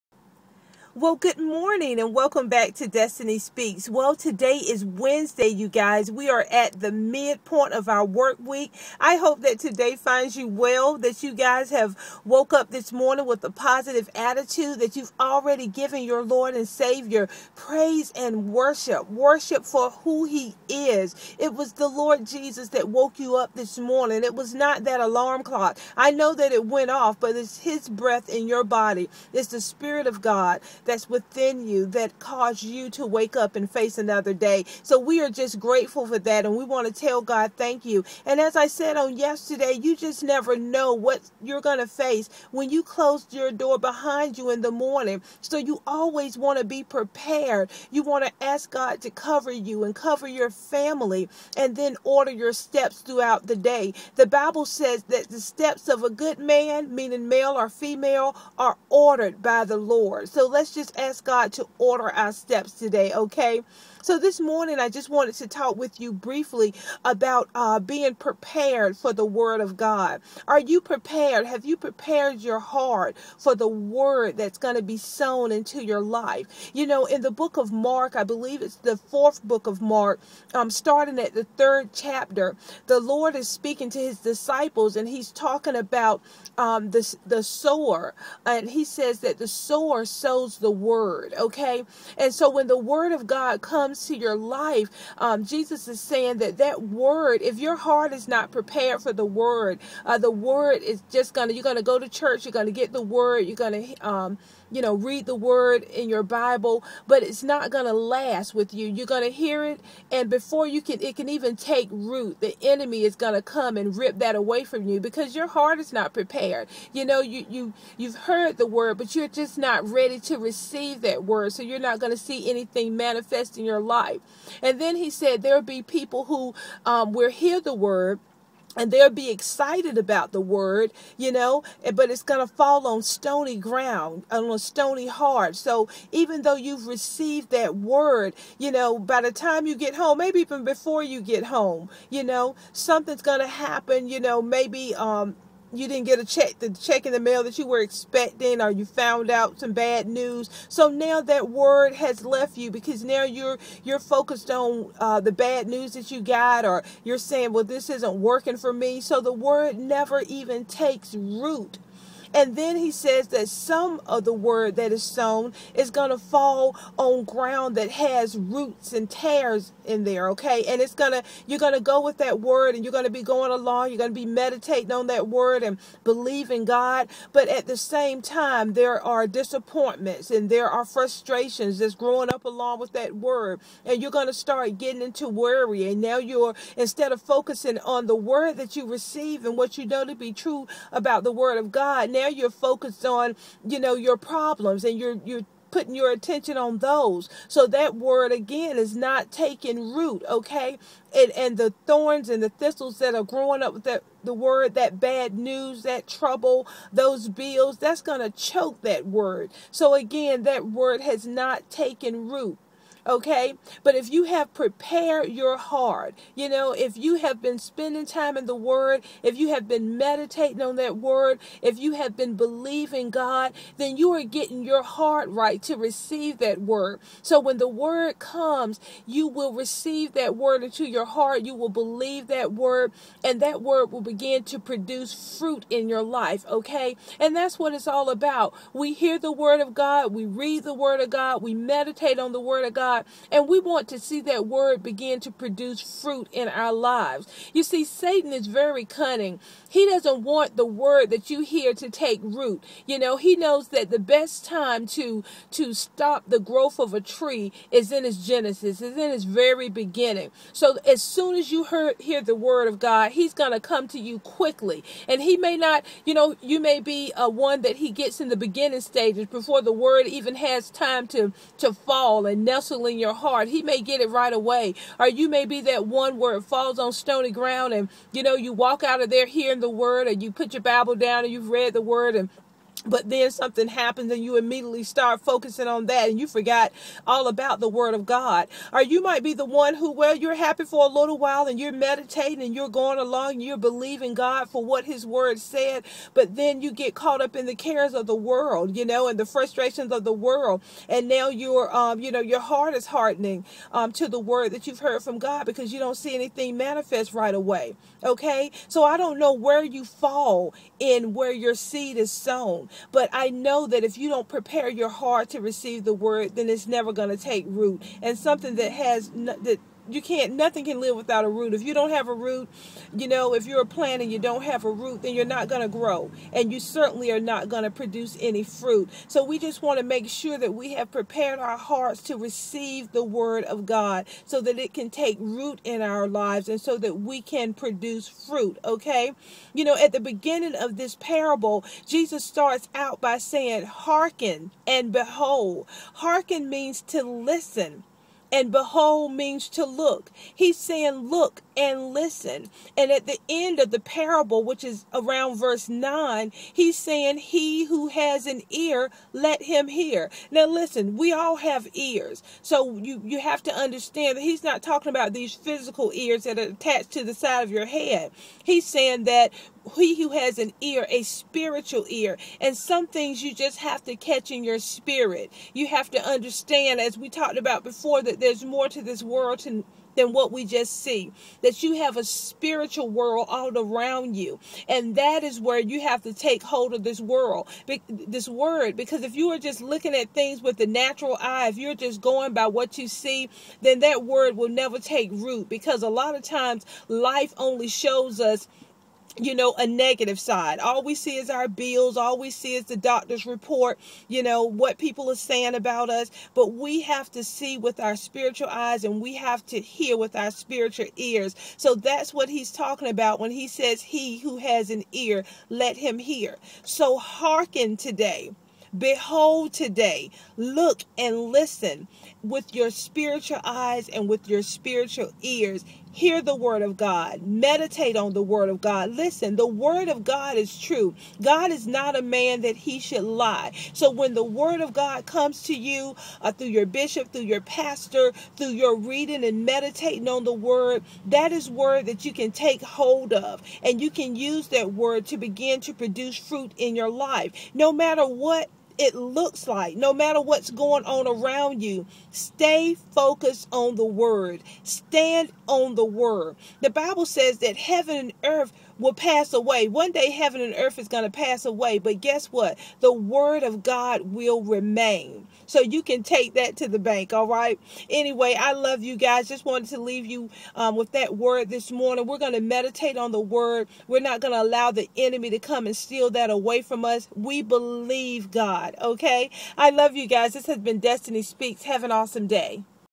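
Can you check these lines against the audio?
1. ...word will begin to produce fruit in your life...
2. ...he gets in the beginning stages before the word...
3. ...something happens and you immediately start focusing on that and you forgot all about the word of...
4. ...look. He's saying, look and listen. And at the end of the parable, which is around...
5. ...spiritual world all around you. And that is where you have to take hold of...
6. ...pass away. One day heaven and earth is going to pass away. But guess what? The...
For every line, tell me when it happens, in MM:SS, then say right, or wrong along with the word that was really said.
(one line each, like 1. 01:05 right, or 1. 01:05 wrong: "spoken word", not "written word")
1. 03:53 right
2. 04:27 right
3. 04:43 right
4. 05:49 right
5. 06:22 right
6. 07:38 right.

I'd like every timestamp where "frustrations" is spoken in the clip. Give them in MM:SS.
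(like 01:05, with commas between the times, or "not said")
03:00, 04:59.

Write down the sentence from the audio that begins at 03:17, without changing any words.
So that word again is not taking root, okay?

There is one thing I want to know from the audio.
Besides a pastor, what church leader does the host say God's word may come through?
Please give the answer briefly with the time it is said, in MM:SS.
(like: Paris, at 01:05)
Bishop, at 07:16.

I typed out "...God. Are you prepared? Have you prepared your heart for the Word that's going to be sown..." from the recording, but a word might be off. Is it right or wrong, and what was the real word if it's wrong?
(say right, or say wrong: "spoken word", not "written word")
right.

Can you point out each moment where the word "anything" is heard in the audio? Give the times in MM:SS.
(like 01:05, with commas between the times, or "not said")
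02:02, 05:06.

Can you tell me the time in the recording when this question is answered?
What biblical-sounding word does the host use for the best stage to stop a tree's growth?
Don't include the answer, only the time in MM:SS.
04:18.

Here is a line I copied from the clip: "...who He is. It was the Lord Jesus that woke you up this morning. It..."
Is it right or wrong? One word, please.
right.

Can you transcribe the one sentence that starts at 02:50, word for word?
And it's going to, you're going to go with that word and you're going to be going along.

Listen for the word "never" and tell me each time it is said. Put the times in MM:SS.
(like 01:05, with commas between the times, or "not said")
00:40, 02:39, 05:16, 06:34.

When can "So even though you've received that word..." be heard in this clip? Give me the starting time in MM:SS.
02:15.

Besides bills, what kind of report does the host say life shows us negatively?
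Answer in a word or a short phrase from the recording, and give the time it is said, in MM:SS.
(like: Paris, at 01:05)
The doctor's report, at 06:42.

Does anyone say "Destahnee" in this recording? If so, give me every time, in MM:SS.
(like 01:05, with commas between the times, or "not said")
00:02, 08:00.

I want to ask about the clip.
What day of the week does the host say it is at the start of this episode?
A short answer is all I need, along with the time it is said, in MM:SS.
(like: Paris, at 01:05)
Wednesday, at 00:04.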